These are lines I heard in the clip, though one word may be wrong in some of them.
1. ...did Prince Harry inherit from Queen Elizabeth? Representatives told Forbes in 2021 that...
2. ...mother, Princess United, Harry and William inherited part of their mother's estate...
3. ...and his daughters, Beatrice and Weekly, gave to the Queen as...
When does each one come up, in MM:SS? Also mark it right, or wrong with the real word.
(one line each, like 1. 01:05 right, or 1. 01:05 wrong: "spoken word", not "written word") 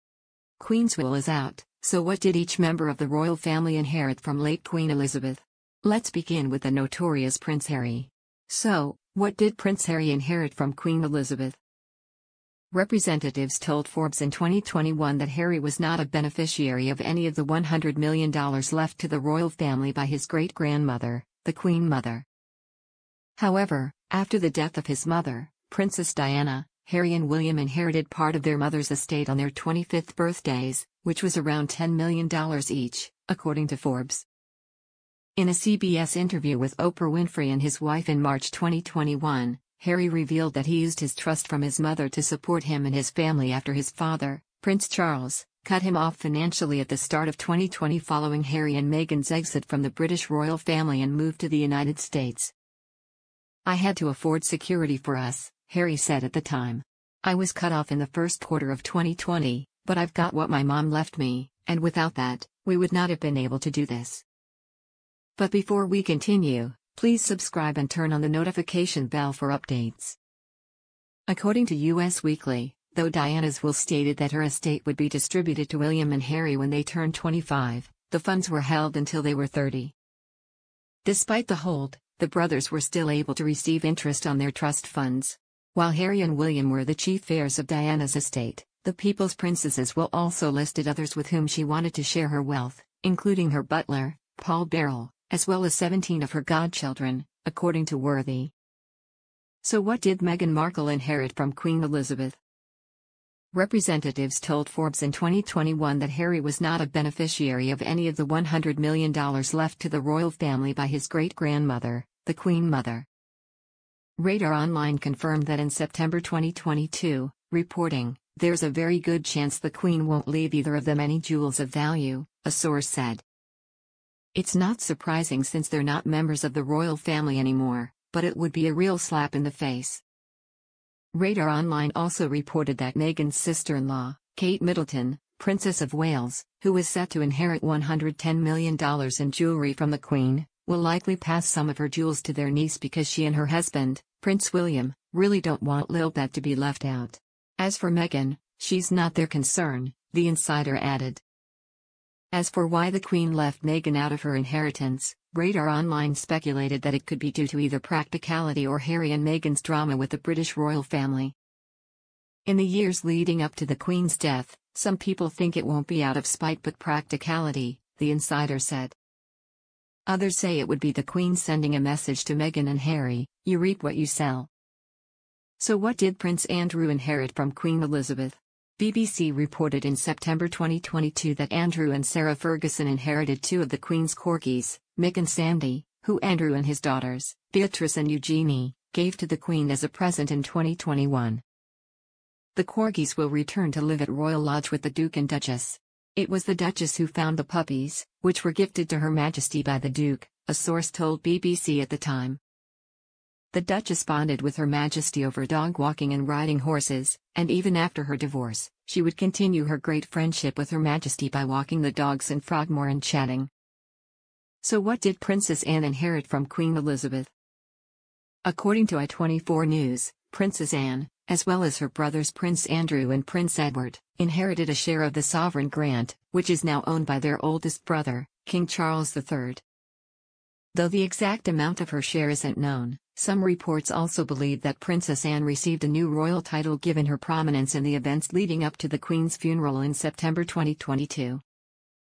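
1. 00:09 right
2. 00:25 wrong: "Diana", not "United"
3. 03:06 wrong: "Eugenie", not "Weekly".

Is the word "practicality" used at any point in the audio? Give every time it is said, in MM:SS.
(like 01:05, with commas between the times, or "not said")
02:37, 02:46.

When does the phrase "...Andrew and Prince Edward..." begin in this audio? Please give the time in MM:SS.
03:42.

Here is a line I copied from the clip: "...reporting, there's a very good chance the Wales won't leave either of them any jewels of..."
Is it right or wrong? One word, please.
wrong.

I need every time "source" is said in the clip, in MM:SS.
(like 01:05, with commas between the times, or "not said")
02:02, 03:20.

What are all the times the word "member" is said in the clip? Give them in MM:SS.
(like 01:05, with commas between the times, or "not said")
00:02, 02:06.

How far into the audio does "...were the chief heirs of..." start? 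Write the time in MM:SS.
01:26.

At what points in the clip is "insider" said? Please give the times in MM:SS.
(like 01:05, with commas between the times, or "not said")
02:30, 02:48.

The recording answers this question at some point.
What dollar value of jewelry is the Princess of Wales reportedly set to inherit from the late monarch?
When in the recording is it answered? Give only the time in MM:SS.
02:17.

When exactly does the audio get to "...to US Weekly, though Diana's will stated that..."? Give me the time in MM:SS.
01:11.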